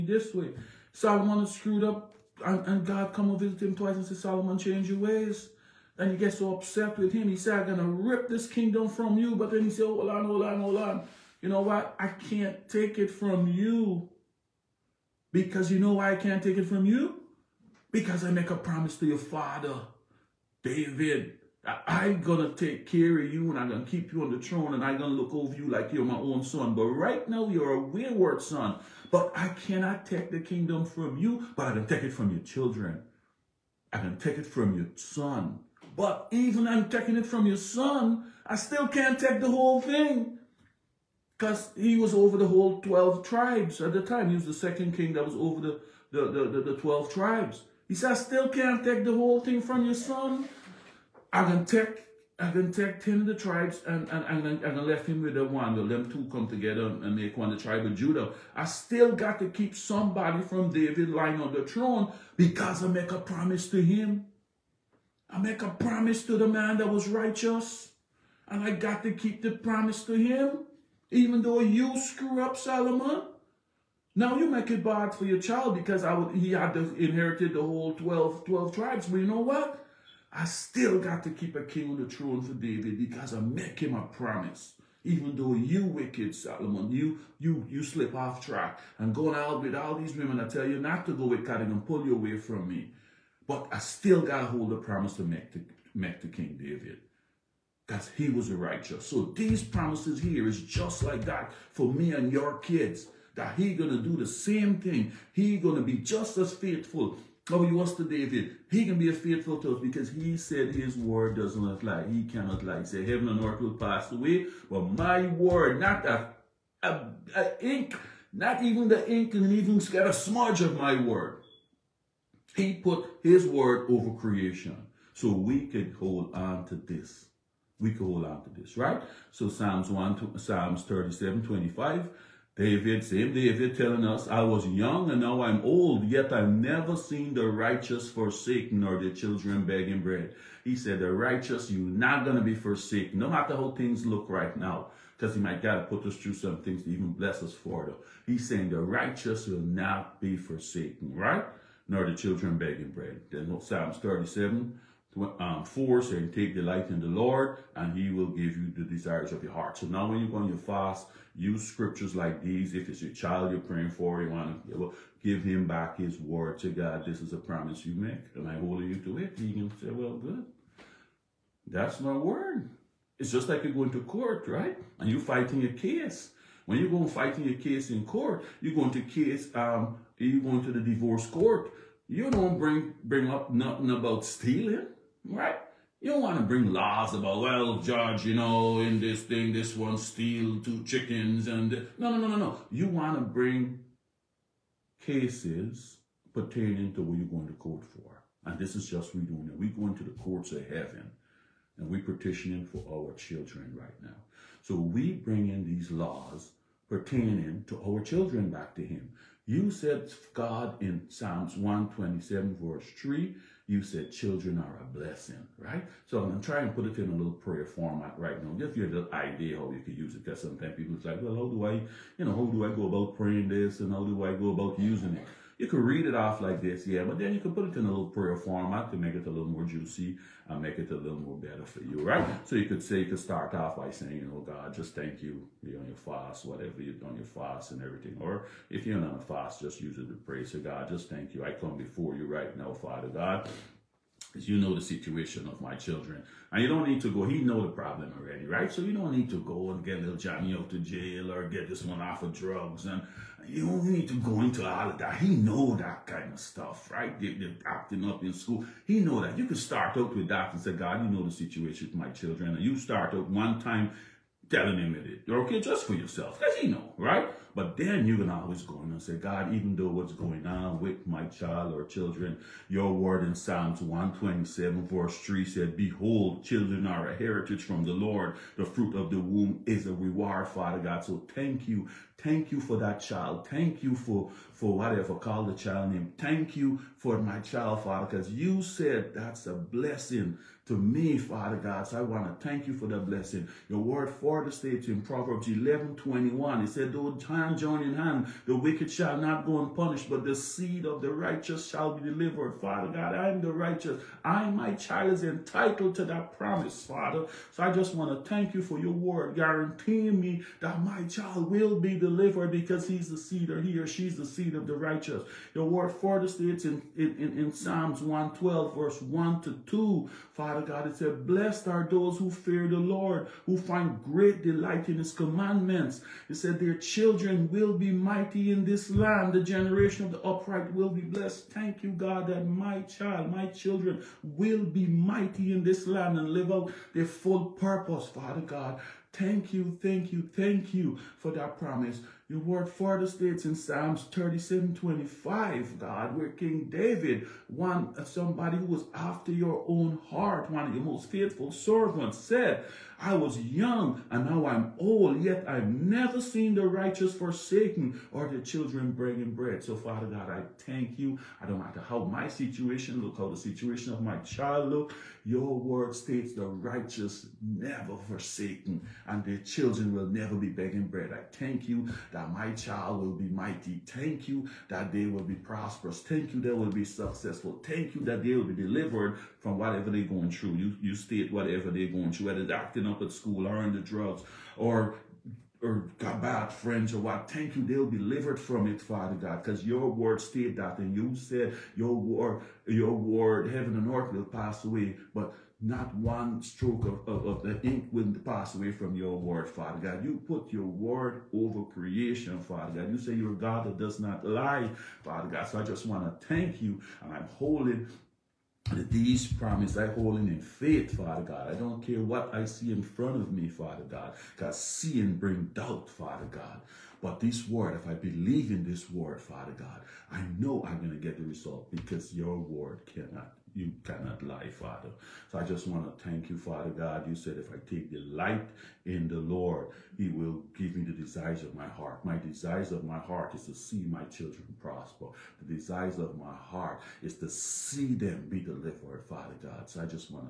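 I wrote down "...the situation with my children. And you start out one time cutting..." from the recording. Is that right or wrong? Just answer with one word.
wrong.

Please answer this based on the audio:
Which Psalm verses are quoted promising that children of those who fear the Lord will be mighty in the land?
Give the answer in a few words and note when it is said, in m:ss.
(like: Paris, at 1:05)
Psalms 112:1-2, at 5:17.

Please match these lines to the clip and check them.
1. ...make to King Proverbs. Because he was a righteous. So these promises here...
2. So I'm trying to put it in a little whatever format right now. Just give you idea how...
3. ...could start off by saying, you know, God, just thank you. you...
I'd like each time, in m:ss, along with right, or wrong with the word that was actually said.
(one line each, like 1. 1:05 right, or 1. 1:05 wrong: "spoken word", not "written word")
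1. 1:35 wrong: "David", not "Proverbs"
2. 3:36 wrong: "prayer", not "whatever"
3. 3:53 right.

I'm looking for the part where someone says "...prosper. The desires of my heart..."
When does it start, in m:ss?
7:14.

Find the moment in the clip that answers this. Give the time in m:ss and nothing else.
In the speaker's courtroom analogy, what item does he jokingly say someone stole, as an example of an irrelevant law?
3:10.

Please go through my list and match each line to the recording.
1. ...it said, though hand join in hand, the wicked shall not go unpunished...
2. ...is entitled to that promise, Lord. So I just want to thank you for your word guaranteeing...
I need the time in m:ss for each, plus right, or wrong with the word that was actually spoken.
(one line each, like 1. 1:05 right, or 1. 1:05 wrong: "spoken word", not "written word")
1. 4:56 right
2. 5:05 wrong: "Father", not "Lord".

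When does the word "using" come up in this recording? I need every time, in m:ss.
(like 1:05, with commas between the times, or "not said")
3:44.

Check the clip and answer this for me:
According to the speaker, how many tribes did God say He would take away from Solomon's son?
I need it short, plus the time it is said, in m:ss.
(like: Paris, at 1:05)
10, at 0:53.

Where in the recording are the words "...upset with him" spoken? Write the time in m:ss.
0:06.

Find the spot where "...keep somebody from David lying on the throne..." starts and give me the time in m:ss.
0:59.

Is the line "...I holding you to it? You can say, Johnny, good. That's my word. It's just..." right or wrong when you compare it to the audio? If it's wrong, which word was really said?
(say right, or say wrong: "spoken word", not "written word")
wrong: "Well", not "Johnny".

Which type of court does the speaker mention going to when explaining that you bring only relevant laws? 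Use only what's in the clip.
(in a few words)
divorce court.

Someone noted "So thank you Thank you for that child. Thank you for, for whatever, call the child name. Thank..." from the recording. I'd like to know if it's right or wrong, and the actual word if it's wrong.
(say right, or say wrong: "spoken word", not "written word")
right.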